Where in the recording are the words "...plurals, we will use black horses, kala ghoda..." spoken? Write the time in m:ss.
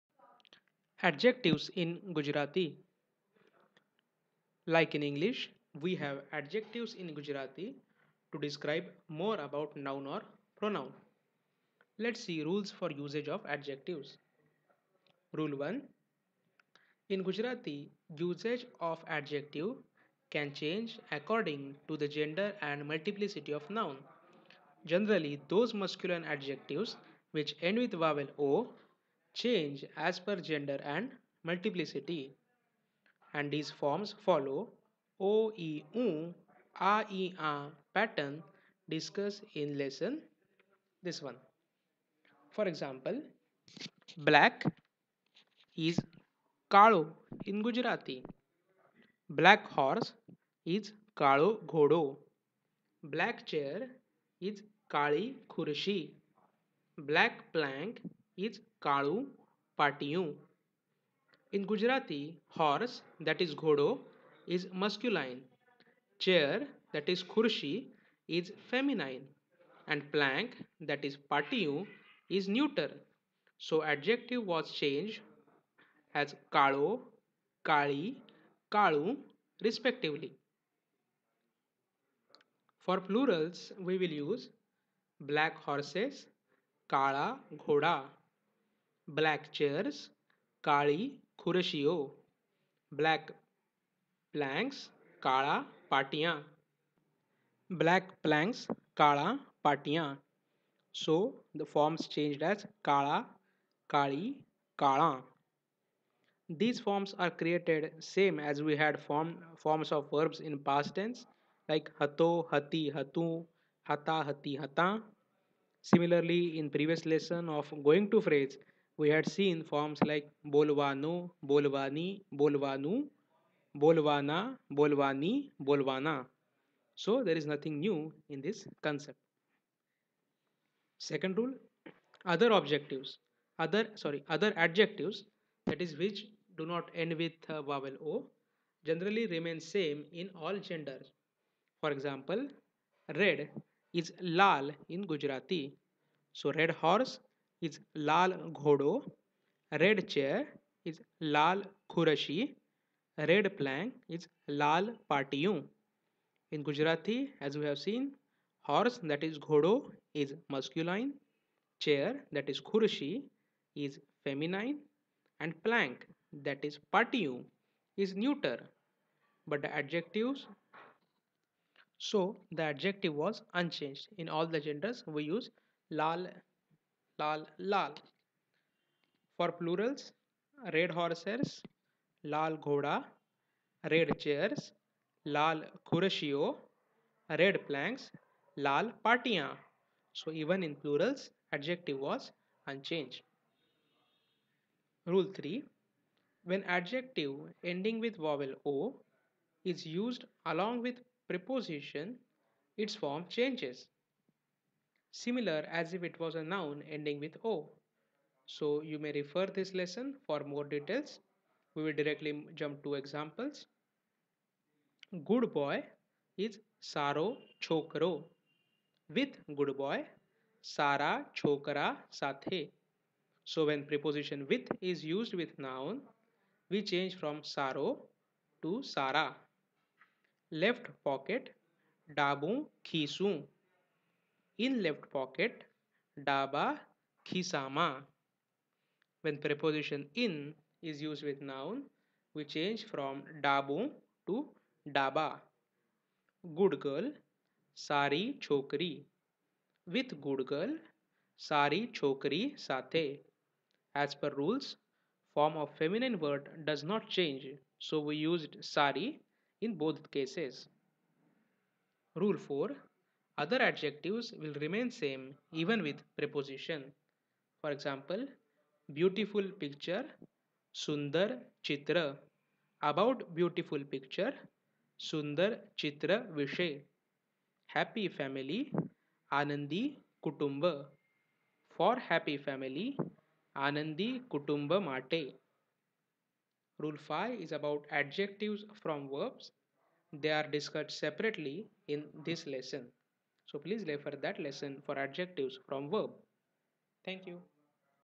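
1:23.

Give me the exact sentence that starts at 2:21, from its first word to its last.
For example, red is lal in Gujarati.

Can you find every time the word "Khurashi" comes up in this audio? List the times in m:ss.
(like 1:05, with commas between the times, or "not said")
2:31, 2:42.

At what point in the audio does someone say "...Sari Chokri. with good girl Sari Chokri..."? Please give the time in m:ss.
4:07.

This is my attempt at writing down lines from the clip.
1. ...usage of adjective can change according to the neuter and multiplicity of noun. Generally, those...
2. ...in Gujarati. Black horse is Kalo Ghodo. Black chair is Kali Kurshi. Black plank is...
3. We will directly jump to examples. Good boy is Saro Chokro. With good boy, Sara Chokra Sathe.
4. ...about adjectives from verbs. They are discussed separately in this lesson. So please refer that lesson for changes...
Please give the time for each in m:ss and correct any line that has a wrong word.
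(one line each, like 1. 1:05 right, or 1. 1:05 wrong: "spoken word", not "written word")
1. 0:18 wrong: "gender", not "neuter"
2. 0:47 right
3. 3:31 right
4. 4:47 wrong: "adjectives", not "changes".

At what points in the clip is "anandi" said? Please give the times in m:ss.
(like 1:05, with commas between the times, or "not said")
4:39, 4:43.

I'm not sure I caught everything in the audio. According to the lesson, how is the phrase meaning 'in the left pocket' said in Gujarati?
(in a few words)
daba khisama.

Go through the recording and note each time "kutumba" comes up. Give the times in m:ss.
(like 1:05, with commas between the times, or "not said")
4:40, 4:44.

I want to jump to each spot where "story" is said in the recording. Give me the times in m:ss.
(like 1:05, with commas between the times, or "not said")
not said.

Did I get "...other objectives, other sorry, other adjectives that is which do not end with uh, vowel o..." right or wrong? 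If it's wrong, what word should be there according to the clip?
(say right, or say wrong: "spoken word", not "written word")
right.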